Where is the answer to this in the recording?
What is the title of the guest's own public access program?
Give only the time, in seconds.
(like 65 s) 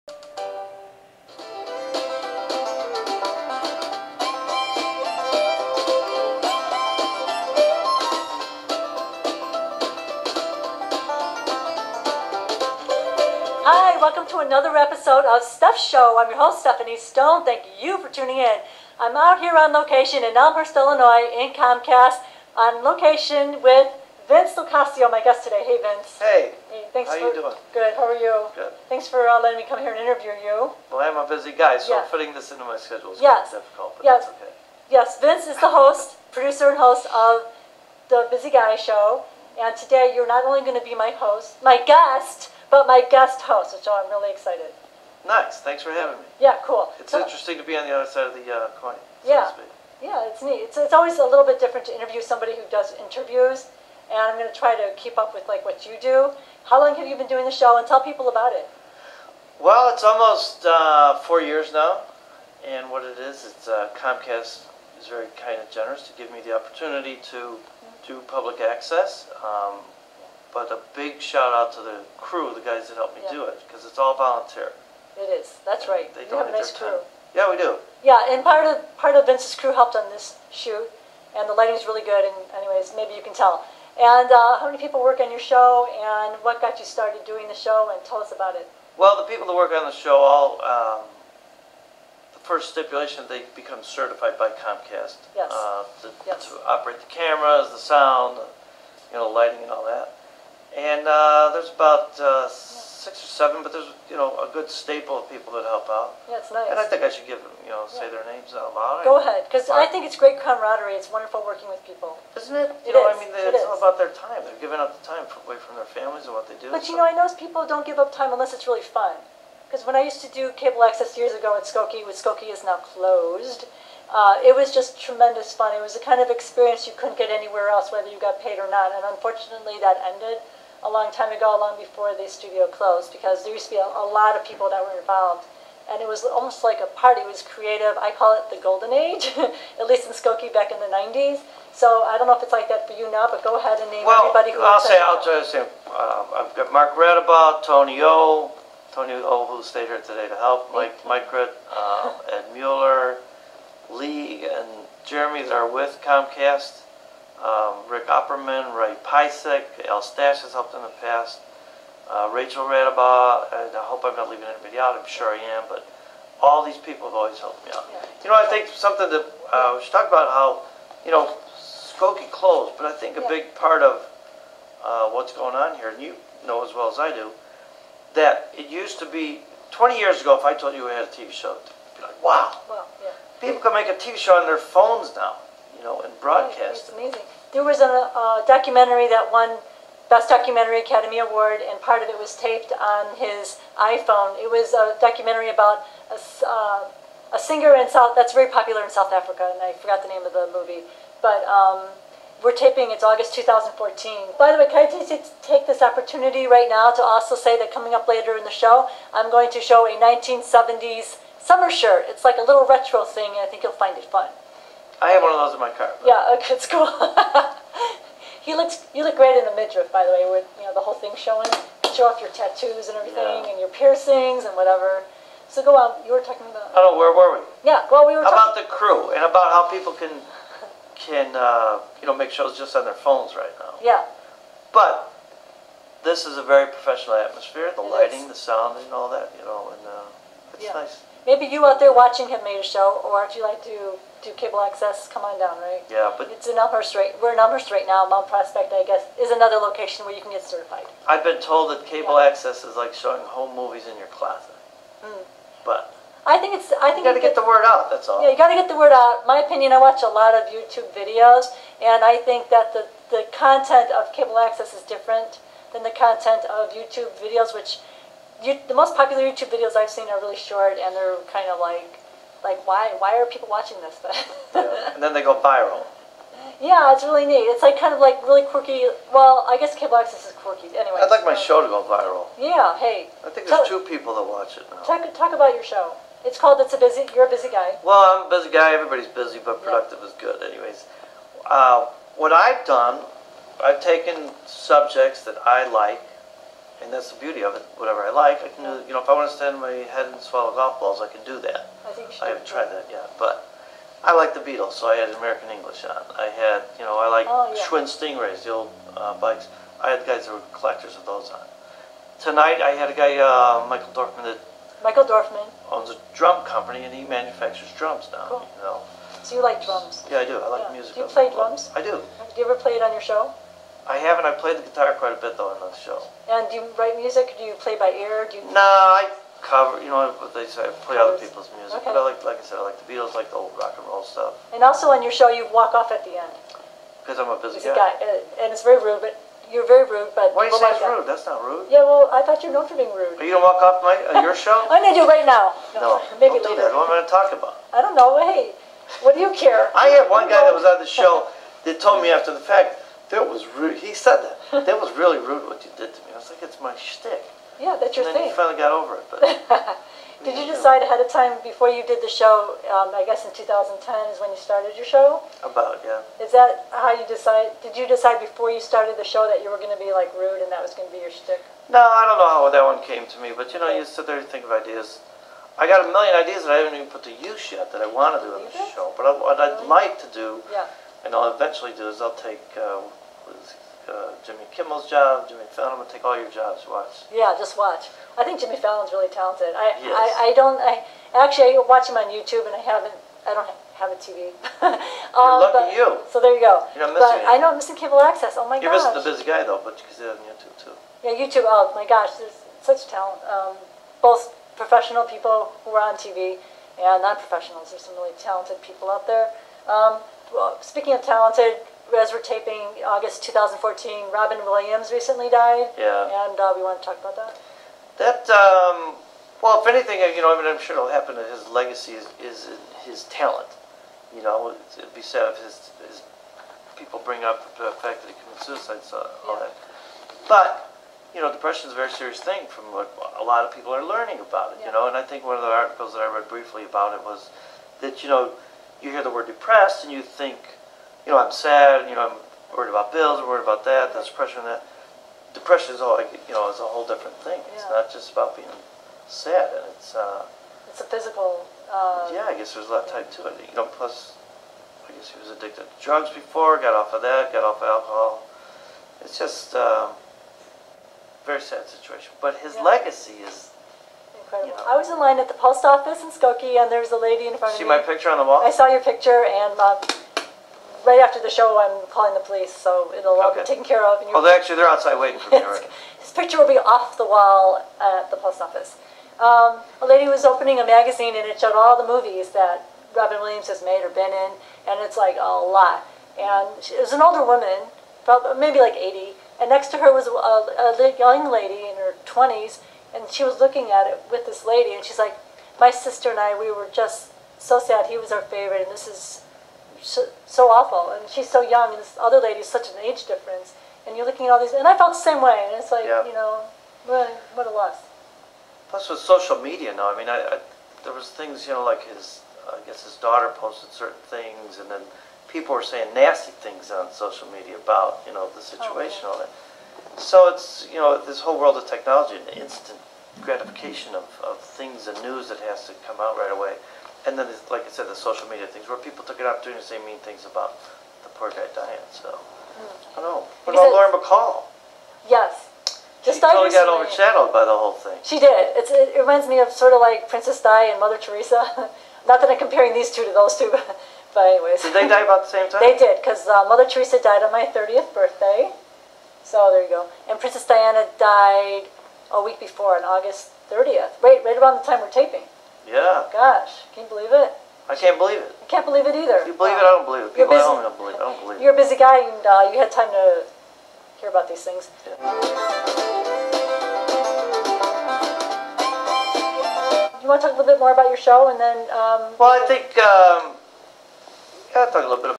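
38 s.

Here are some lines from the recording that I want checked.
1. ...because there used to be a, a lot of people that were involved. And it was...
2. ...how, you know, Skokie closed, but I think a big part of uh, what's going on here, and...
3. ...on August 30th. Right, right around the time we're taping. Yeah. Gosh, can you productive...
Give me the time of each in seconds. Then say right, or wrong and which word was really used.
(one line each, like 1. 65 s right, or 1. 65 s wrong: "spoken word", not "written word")
1. 133 s right
2. 170 s right
3. 552 s wrong: "believe", not "productive".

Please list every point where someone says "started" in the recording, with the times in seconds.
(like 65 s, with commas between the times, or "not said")
86 s, 364 s, 368 s.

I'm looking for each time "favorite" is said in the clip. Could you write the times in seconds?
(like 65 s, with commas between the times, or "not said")
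498 s.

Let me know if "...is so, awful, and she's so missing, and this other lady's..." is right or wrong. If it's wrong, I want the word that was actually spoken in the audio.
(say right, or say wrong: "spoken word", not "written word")
wrong: "young", not "missing".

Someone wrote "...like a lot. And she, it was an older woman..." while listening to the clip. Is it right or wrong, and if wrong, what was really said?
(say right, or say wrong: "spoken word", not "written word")
right.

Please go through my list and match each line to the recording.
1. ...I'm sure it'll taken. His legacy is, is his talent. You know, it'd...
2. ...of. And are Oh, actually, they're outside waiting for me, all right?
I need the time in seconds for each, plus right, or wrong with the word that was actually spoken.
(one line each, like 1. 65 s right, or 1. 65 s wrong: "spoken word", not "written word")
1. 420 s wrong: "happen", not "taken"
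2. 473 s right.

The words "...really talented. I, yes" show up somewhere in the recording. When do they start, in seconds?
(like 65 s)
388 s.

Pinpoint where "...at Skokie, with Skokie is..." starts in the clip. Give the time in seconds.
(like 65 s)
121 s.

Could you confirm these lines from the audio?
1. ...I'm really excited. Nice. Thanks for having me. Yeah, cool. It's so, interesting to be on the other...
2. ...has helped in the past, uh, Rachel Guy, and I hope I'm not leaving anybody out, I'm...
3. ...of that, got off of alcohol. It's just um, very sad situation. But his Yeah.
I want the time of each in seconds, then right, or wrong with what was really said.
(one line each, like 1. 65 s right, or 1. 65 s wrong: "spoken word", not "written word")
1. 43 s right
2. 160 s wrong: "Radabaugh", not "Guy"
3. 456 s right.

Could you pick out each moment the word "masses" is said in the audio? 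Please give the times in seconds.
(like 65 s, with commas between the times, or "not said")
not said.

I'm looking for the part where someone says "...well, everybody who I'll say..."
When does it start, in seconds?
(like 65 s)
144 s.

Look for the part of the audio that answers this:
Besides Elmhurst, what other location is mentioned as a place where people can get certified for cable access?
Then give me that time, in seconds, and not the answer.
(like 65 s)
248 s.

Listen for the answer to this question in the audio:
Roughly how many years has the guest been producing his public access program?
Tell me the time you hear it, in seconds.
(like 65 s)
61 s.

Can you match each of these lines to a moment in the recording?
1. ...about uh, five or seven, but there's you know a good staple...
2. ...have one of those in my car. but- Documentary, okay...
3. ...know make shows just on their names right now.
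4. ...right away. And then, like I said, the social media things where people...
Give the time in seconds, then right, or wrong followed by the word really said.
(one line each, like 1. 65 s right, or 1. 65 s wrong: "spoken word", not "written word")
1. 101 s wrong: "six", not "five"
2. 215 s wrong: "Yeah", not "Documentary"
3. 232 s wrong: "phones", not "names"
4. 526 s right.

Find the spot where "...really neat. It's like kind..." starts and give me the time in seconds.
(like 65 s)
277 s.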